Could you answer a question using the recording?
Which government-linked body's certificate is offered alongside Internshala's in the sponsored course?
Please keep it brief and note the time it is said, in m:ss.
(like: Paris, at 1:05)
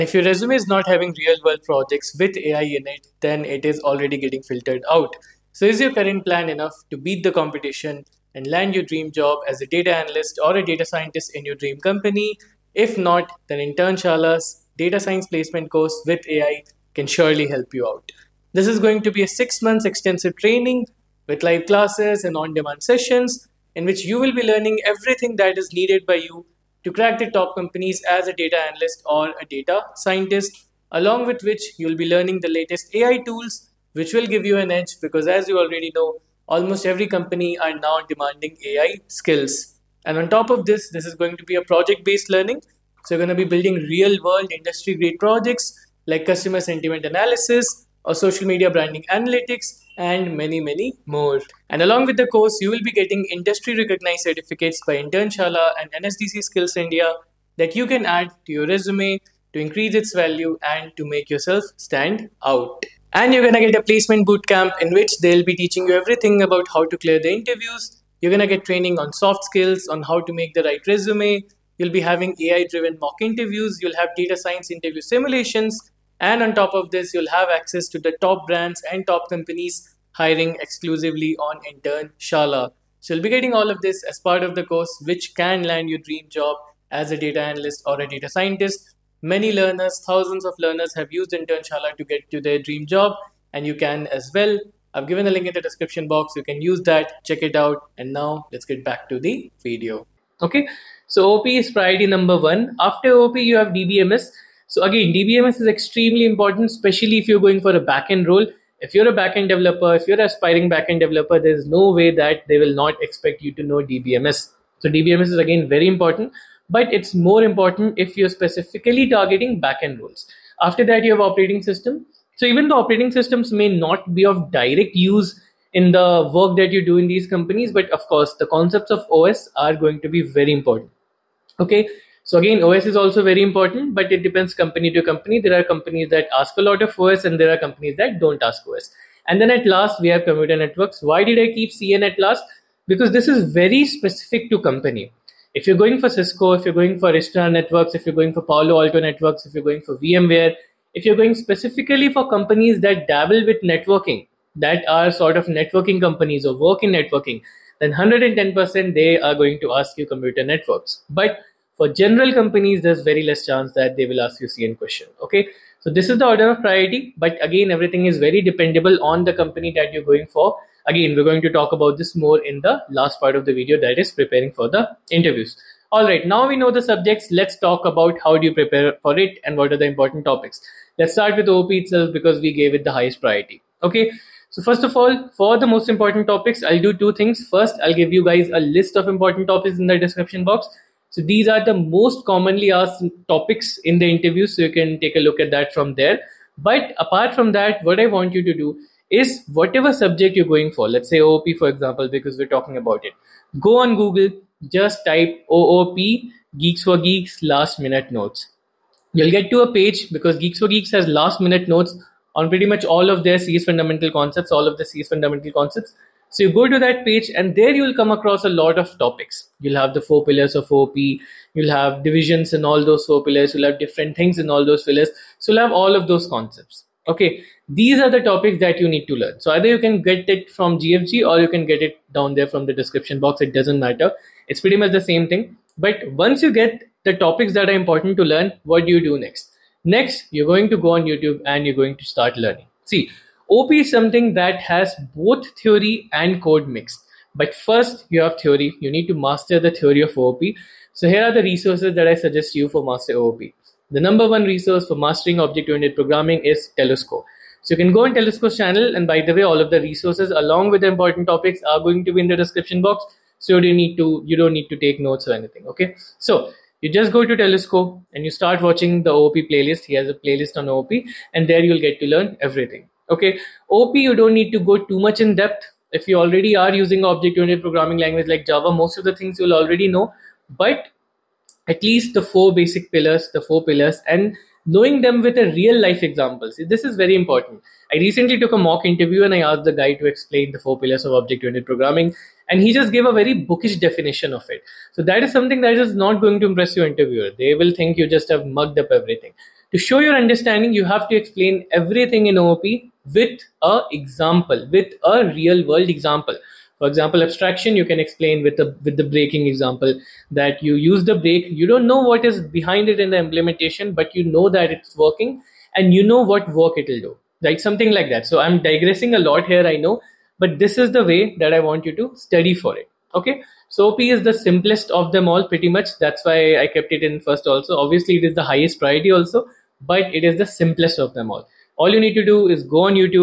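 NSDC Skills India, at 0:56.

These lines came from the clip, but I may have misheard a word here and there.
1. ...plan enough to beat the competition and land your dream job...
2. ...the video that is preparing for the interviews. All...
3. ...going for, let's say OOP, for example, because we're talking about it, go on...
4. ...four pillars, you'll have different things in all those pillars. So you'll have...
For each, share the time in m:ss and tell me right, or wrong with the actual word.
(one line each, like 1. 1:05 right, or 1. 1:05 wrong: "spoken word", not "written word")
1. 0:06 right
2. 2:53 right
3. 3:20 right
4. 3:43 right.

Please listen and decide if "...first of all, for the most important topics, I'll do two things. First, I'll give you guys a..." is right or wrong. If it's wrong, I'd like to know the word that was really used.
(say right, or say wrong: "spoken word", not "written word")
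right.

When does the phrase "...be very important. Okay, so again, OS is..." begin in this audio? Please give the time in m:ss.
2:10.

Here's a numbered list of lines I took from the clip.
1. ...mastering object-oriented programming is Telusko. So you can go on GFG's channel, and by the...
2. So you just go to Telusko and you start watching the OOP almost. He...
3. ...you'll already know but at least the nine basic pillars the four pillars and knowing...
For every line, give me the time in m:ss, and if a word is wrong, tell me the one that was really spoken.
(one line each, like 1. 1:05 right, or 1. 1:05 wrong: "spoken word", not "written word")
1. 4:14 wrong: "Telusko", not "GFG"
2. 4:26 wrong: "playlist", not "almost"
3. 4:39 wrong: "four", not "nine".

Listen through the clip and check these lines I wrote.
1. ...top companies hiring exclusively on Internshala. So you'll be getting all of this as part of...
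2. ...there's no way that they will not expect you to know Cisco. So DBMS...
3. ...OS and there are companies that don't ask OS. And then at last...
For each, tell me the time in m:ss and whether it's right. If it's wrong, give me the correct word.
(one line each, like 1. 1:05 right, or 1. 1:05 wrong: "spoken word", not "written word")
1. 1:19 right
2. 1:51 wrong: "DBMS", not "Cisco"
3. 2:16 right.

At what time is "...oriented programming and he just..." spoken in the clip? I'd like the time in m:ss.
4:51.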